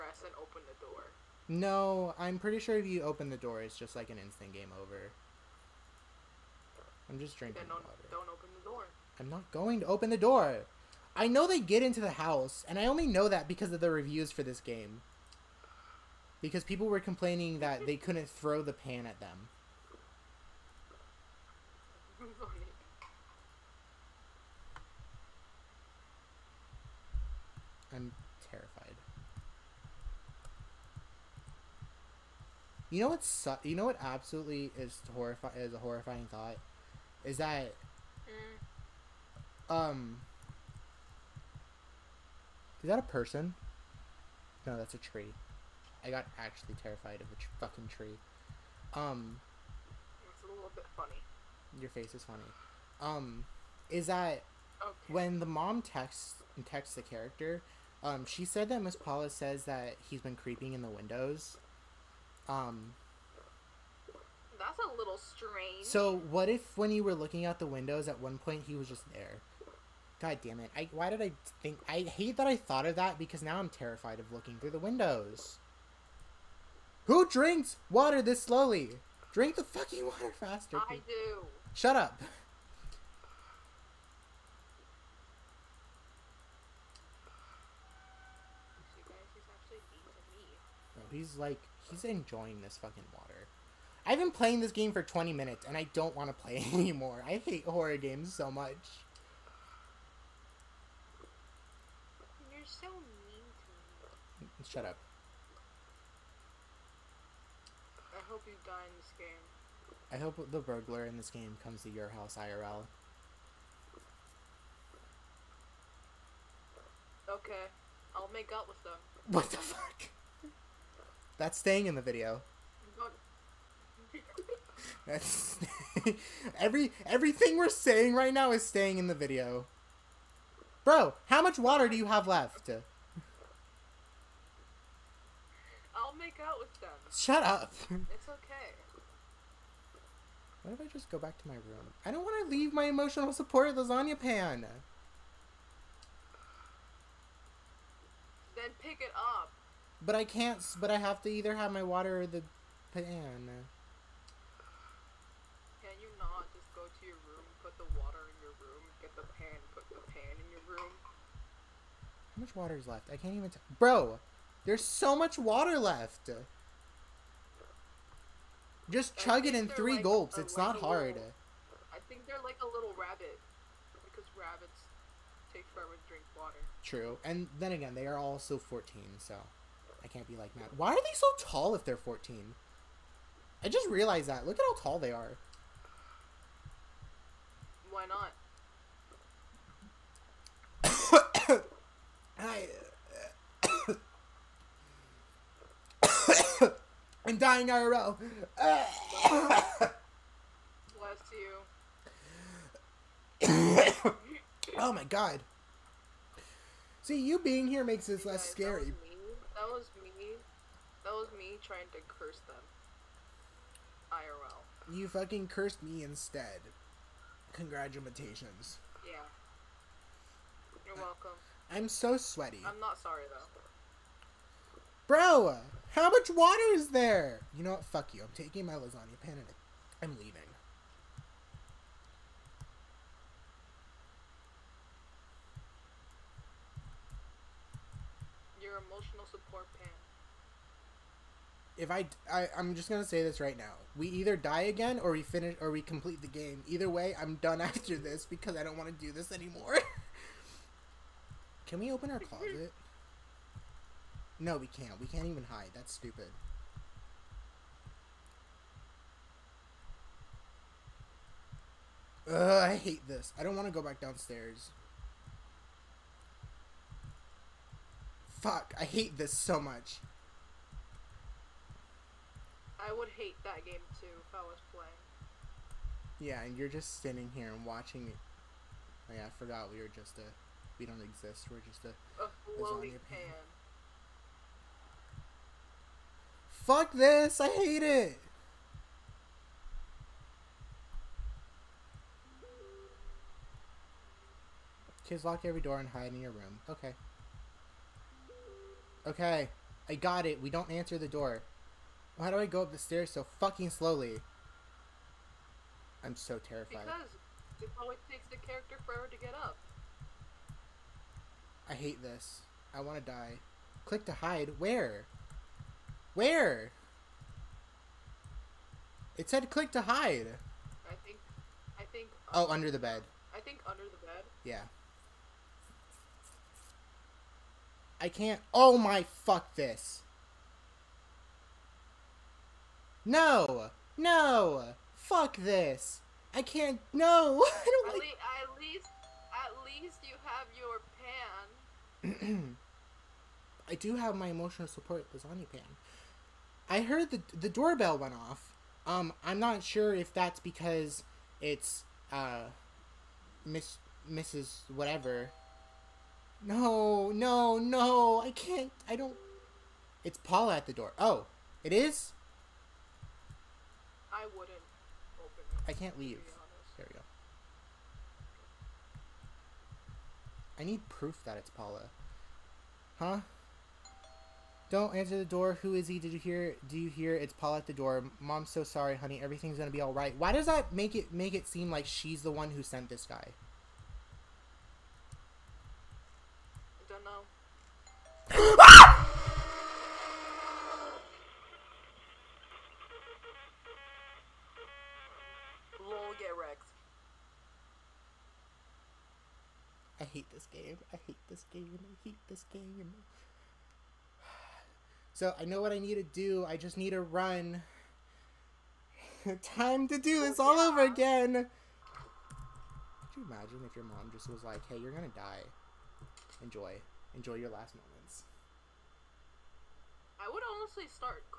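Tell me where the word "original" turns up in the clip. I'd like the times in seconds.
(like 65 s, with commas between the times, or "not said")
not said.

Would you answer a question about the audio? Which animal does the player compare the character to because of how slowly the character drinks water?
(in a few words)
rabbit.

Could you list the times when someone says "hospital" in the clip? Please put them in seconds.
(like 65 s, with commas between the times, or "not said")
not said.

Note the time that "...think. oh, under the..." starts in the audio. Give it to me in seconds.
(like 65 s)
321 s.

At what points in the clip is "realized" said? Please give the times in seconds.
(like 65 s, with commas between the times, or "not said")
183 s.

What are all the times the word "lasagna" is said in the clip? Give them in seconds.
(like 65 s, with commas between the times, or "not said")
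143 s, 228 s, 345 s.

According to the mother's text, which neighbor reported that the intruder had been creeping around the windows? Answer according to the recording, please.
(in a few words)
Miss Paula.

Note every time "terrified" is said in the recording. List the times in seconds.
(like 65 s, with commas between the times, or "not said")
28 s, 46 s, 73 s, 306 s.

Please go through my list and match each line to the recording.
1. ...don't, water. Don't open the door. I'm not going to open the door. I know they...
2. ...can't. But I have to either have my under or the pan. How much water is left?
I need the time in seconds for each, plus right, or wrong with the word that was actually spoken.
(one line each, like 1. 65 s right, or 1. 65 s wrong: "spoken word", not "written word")
1. 7 s right
2. 150 s wrong: "water", not "under".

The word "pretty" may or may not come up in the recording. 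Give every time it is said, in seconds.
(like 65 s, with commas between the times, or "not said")
2 s.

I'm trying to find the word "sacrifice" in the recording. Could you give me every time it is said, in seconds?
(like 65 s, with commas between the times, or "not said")
not said.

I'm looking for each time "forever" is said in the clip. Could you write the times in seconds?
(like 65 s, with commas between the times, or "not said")
175 s, 308 s.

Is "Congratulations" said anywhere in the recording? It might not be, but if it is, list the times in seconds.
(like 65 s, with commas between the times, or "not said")
217 s.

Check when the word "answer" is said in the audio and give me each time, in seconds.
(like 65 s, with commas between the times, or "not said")
300 s, 374 s.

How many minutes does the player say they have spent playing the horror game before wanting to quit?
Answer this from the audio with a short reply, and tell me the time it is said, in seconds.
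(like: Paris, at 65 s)
20, at 95 s.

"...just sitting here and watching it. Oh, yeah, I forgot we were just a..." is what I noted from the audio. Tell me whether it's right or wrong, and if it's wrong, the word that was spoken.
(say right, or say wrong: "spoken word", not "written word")
right.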